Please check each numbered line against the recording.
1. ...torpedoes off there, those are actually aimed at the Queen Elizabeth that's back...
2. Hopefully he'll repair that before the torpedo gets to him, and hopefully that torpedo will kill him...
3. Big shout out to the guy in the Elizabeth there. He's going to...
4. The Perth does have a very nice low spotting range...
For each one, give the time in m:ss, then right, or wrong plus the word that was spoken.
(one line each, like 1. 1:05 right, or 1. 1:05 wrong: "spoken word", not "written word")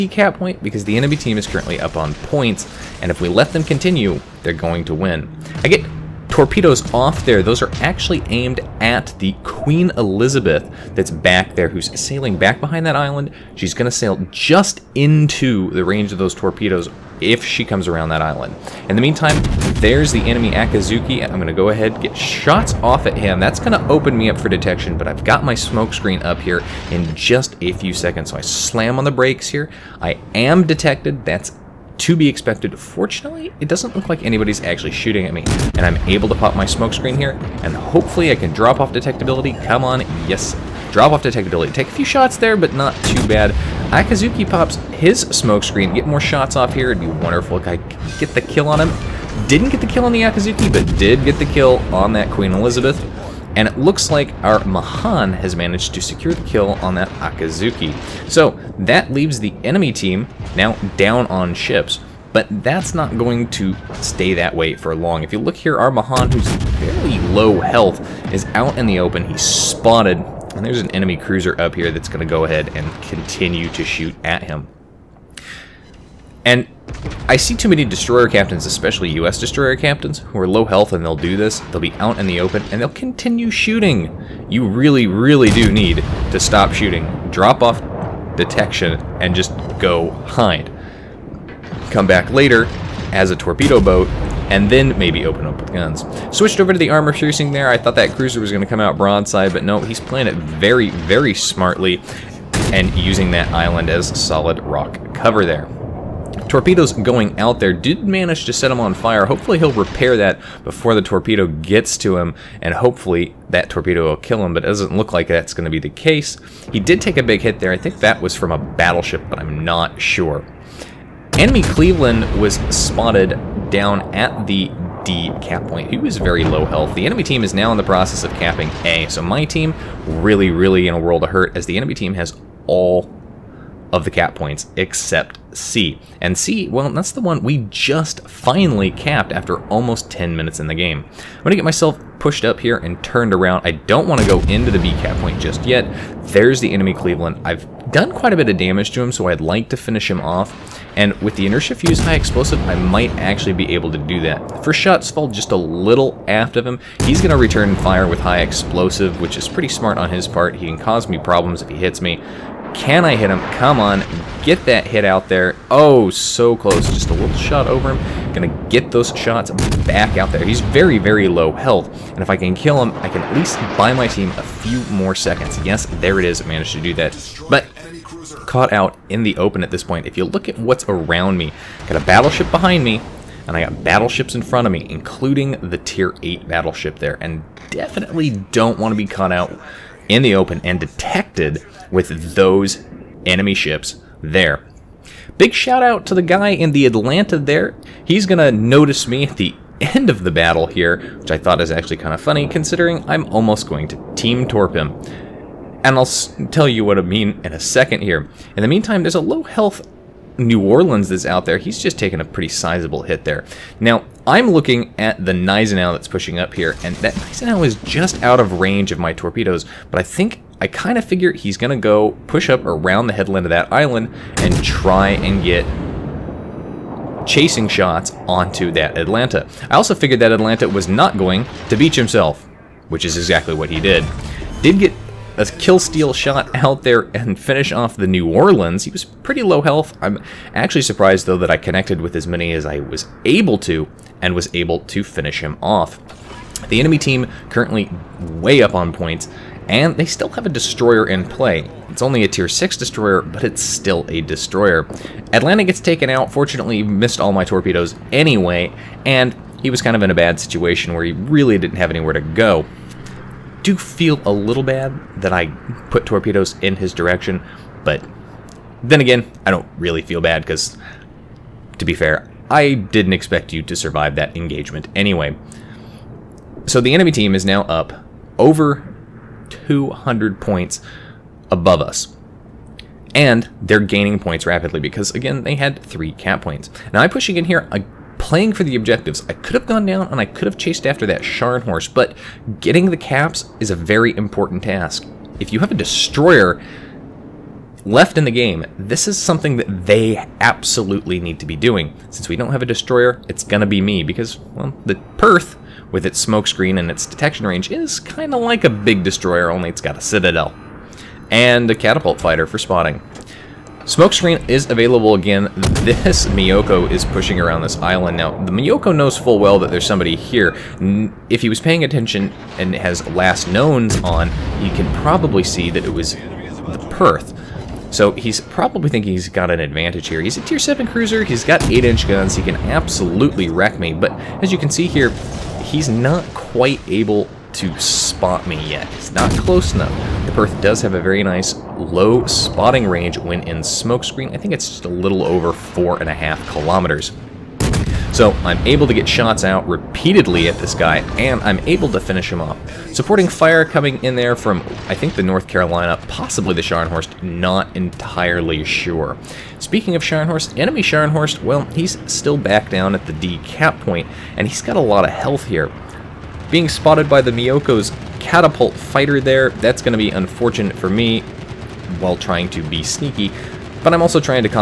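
1. 0:06 right
2. 1:49 right
3. 3:15 wrong: "Atlanta", not "Elizabeth"
4. 5:40 right.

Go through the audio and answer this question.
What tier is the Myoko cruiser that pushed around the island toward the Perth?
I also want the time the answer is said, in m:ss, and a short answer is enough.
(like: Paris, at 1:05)
7, at 5:30.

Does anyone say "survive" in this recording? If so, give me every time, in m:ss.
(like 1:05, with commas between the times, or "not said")
4:33.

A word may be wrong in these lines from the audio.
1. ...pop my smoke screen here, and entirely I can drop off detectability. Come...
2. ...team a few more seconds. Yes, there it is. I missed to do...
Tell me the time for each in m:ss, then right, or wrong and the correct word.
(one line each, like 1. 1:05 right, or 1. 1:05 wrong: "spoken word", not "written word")
1. 0:36 wrong: "hopefully", not "entirely"
2. 2:54 wrong: "managed", not "missed".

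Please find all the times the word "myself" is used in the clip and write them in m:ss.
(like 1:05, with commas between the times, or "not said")
2:21.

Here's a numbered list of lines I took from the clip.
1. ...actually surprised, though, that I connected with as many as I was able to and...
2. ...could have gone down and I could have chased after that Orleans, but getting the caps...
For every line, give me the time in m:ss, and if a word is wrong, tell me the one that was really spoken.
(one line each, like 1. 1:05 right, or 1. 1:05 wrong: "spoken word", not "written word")
1. 4:00 right
2. 4:49 wrong: "Scharnhorst", not "Orleans".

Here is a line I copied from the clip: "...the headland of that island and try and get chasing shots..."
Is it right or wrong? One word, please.
right.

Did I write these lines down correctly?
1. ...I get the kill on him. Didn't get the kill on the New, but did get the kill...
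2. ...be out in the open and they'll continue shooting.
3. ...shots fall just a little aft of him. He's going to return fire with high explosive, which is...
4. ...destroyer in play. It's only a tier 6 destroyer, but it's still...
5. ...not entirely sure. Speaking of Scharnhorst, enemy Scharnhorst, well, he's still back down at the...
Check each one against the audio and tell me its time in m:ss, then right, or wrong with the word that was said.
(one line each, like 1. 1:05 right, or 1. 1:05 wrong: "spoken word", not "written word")
1. 0:47 wrong: "Akazuki", not "New"
2. 1:21 right
3. 2:34 right
4. 4:10 right
5. 5:57 right.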